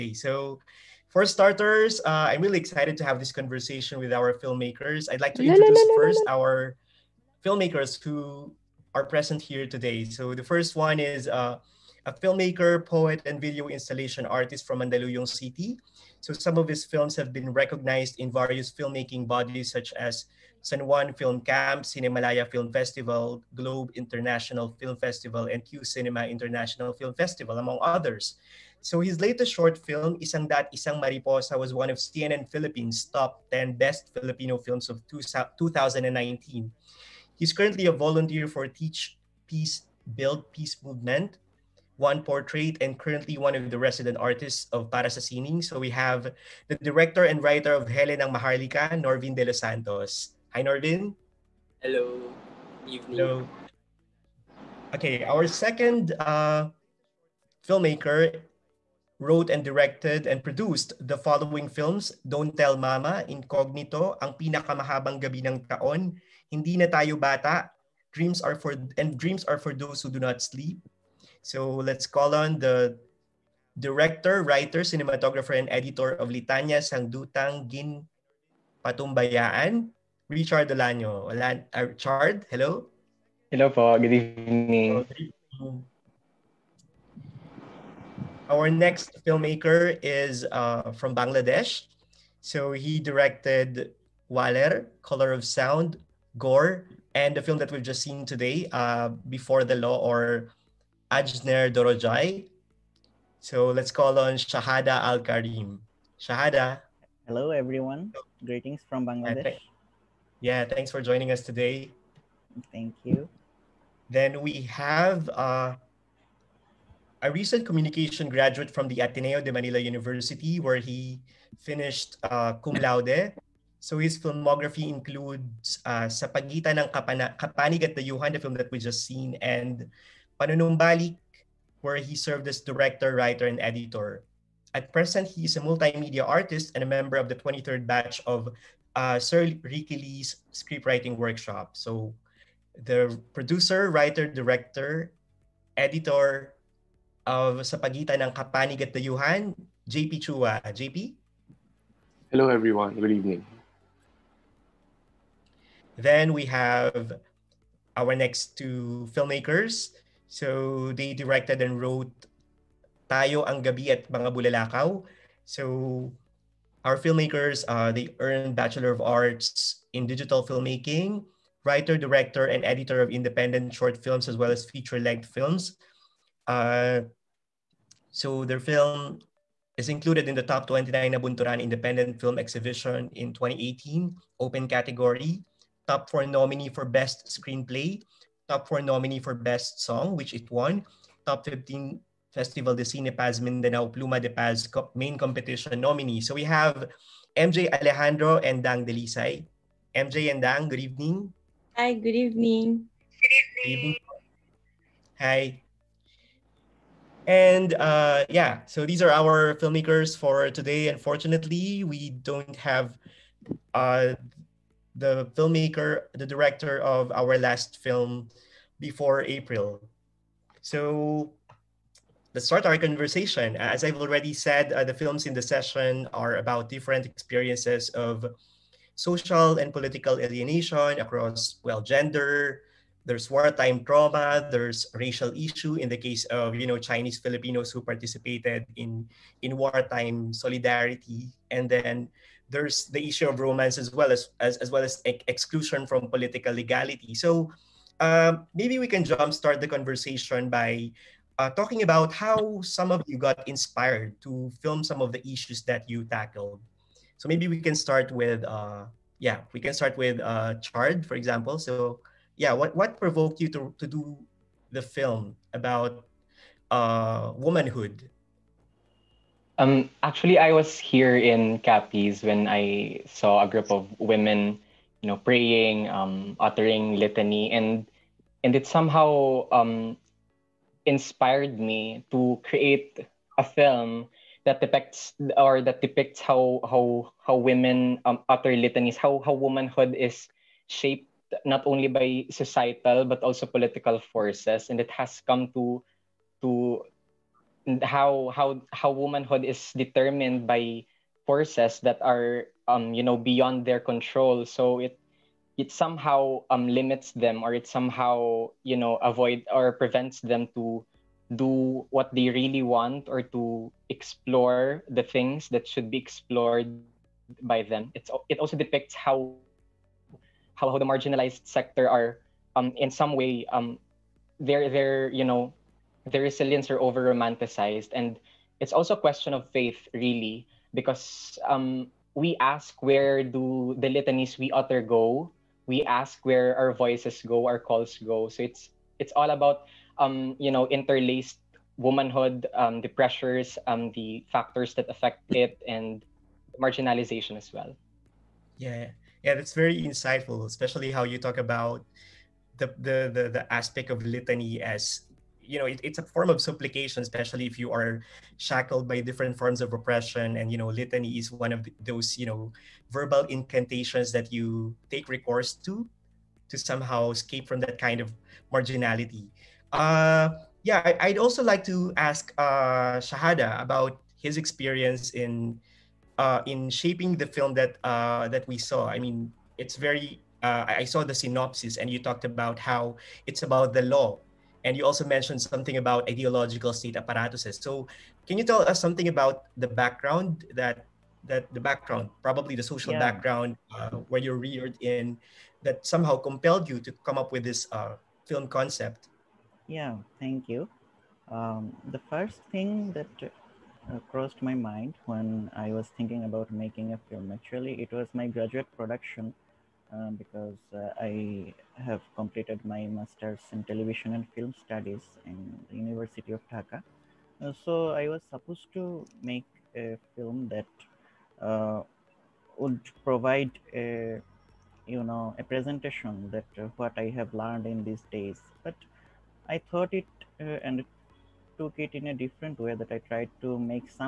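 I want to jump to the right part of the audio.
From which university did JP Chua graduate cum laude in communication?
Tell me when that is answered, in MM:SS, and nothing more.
01:59.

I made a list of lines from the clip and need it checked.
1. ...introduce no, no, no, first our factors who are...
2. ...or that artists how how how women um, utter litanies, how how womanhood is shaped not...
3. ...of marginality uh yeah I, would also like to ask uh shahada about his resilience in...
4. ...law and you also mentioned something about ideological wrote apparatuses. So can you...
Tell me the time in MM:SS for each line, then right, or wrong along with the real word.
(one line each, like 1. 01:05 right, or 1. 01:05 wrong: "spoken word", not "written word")
1. 00:05 wrong: "filmmakers", not "factors"
2. 04:45 wrong: "depicts", not "artists"
3. 06:07 wrong: "experience", not "resilience"
4. 06:23 wrong: "state", not "wrote".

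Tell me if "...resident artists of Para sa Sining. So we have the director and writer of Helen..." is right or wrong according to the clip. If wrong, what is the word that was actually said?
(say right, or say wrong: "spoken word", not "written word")
right.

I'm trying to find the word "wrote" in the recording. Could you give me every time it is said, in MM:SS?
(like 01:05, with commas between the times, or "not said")
00:59, 02:41.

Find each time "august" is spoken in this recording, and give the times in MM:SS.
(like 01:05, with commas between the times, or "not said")
not said.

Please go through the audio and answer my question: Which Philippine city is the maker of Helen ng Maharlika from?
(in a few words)
Mandaluyong City.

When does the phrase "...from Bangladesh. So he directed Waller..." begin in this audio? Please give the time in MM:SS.
01:30.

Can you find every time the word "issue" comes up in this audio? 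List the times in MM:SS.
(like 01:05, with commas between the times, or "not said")
03:55, 04:03, 04:15.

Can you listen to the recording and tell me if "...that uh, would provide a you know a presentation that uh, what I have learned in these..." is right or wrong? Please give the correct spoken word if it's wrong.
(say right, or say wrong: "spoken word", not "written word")
right.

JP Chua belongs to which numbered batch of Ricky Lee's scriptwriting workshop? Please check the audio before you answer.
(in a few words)
23rd.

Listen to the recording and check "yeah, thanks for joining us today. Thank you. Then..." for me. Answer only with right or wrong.
right.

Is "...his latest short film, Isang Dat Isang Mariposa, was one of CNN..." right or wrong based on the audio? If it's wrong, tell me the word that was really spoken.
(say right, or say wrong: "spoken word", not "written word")
right.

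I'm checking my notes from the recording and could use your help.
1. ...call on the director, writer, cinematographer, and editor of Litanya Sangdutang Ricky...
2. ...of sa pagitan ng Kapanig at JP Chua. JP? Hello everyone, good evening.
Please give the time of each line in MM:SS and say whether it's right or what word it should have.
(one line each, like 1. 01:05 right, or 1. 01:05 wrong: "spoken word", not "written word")
1. 01:12 wrong: "Gin", not "Ricky"
2. 02:27 right.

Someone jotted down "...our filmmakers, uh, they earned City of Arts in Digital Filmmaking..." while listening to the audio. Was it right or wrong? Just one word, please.
wrong.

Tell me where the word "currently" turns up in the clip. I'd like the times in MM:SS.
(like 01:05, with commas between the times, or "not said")
00:37, 00:42.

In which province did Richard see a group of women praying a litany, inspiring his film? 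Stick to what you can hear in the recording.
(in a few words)
Capiz.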